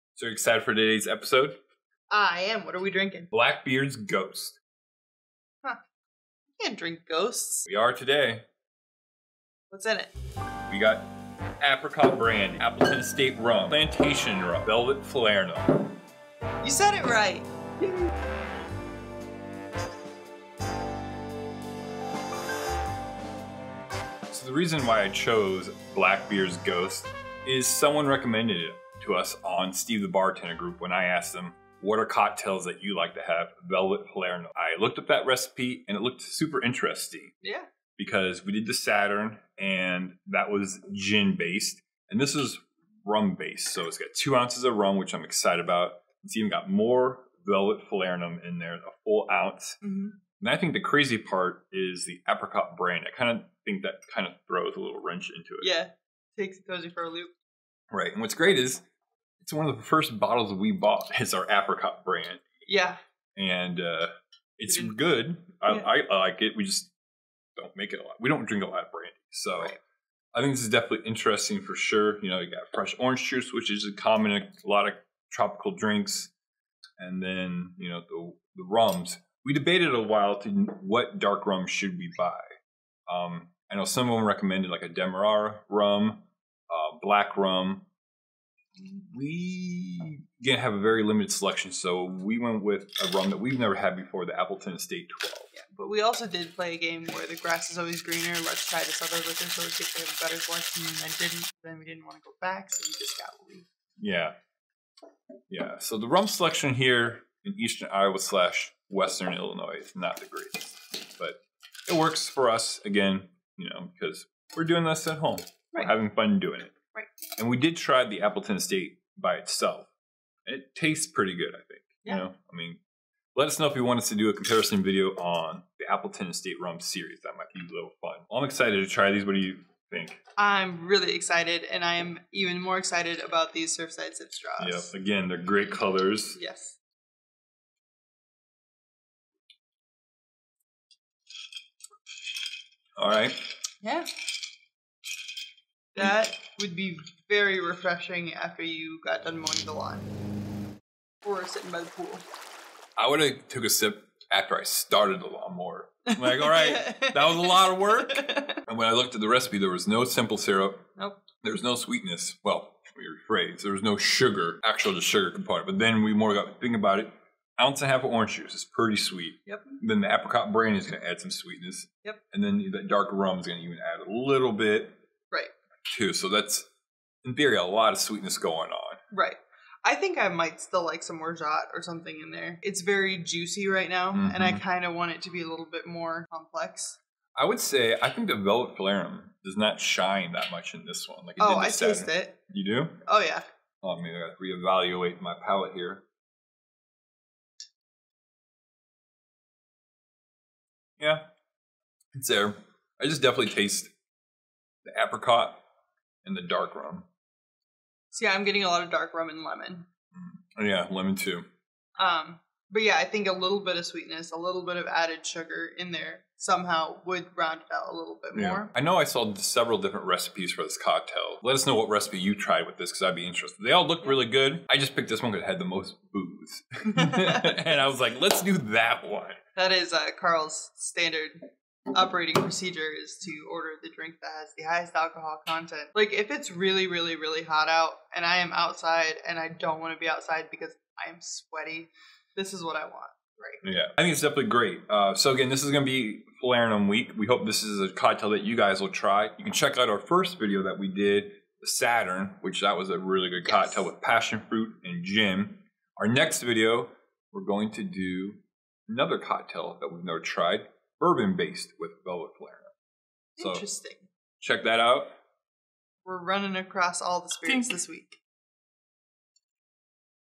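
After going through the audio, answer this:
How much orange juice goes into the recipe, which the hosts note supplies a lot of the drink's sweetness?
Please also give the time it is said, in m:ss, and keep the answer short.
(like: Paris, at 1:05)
1.5 ounces, at 2:47.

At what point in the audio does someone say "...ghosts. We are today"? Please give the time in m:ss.
0:07.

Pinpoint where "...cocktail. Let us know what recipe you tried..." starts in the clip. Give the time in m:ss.
3:40.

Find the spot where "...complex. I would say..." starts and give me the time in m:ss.
3:06.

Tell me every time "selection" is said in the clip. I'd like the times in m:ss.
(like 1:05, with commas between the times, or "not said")
1:31, 1:40, 1:46.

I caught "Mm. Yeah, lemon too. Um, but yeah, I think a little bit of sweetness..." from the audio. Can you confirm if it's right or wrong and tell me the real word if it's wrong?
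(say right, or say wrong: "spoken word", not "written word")
right.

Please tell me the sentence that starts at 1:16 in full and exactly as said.
And then, you know, the, the rums.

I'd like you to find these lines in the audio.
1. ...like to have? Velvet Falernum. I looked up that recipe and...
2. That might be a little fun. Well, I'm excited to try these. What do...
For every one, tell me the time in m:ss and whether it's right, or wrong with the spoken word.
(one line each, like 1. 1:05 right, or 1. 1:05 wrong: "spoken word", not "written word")
1. 0:32 right
2. 2:07 right.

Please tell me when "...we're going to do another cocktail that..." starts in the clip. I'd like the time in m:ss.
4:17.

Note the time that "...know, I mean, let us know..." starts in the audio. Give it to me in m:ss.
2:02.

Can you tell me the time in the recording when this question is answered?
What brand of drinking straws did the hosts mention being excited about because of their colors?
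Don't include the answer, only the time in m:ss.
2:13.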